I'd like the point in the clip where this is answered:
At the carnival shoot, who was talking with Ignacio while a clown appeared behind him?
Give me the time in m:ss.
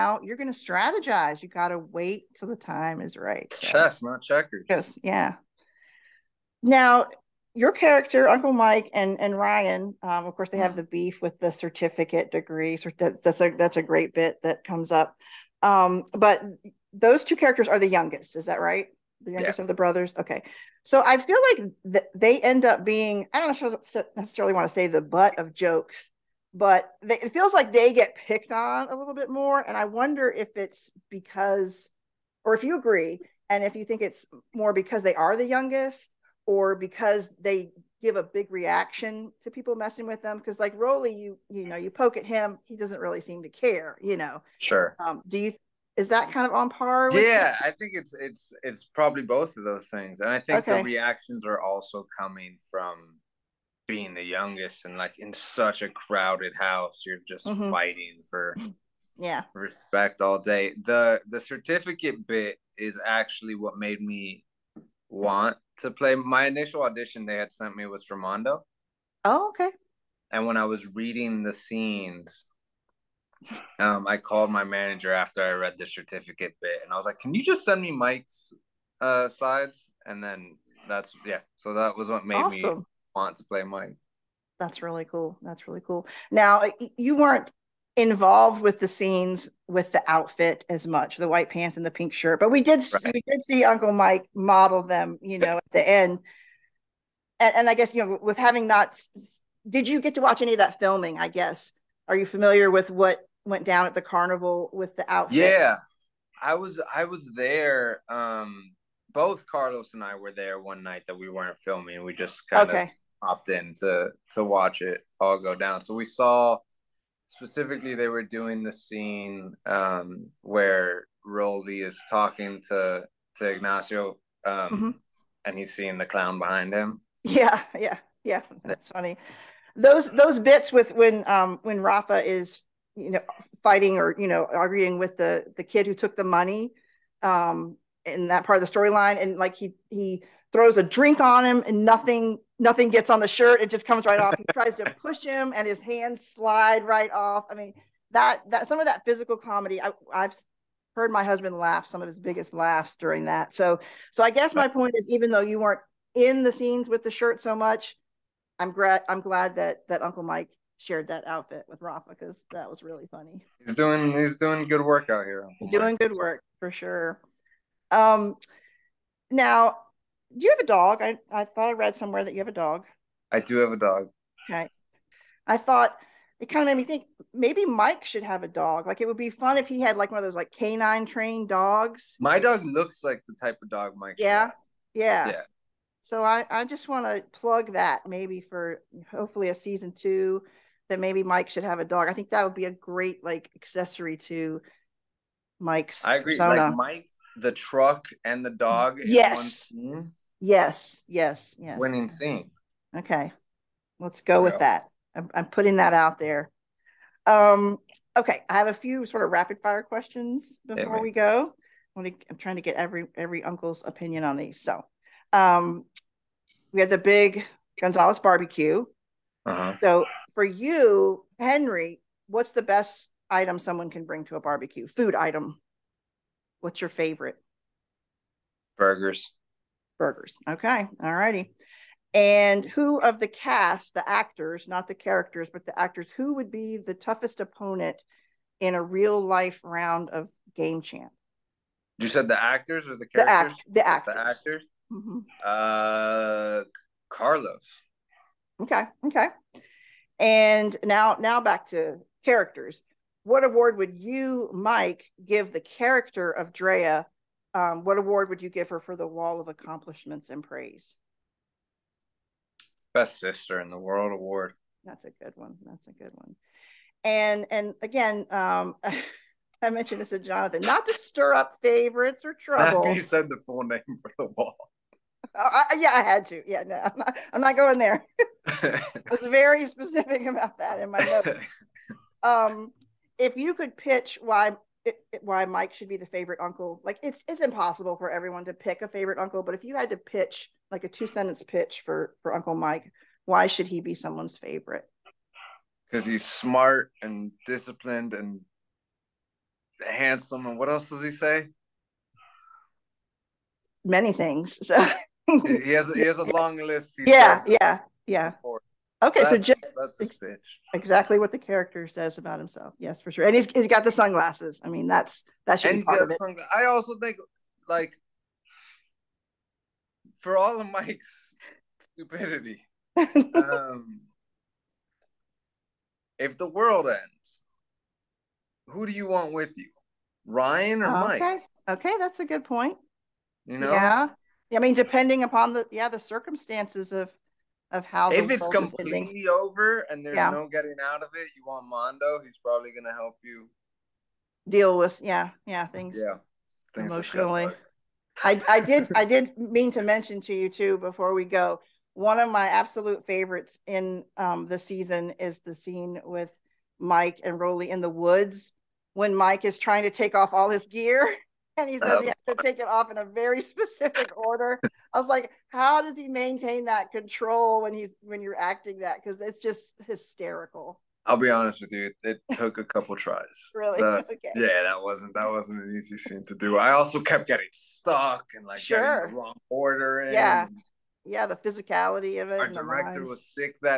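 2:01.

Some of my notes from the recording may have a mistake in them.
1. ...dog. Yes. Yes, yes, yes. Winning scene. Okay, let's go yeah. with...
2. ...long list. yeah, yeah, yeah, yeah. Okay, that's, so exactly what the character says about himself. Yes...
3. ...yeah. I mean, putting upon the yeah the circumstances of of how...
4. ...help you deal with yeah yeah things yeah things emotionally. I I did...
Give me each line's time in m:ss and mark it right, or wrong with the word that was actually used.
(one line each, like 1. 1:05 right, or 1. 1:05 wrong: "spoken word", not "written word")
1. 3:18 right
2. 5:06 right
3. 5:33 wrong: "depending", not "putting"
4. 5:42 right.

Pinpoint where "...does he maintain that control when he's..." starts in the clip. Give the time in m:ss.
6:05.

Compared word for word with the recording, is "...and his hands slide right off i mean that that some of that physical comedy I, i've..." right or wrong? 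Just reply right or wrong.
right.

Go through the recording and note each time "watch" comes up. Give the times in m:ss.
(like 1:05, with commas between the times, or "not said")
1:40, 1:54.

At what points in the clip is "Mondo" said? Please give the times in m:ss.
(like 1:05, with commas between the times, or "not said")
1:08, 5:41.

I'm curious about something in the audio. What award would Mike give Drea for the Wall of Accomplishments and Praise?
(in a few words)
Best Sister in the World Award.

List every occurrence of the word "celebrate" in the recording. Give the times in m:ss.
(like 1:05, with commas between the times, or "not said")
not said.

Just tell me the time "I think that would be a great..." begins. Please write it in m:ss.
3:12.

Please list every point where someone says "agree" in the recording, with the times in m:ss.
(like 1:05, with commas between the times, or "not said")
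0:32, 3:16.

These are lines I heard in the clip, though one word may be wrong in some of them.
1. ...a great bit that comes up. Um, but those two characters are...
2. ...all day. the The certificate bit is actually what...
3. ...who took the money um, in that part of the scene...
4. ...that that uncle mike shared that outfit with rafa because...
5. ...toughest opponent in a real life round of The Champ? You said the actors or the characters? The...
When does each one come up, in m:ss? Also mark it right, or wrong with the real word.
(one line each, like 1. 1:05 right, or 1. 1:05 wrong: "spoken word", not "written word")
1. 0:13 right
2. 1:00 right
3. 2:15 wrong: "storyline", not "scene"
4. 2:39 right
5. 3:56 wrong: "Game", not "The".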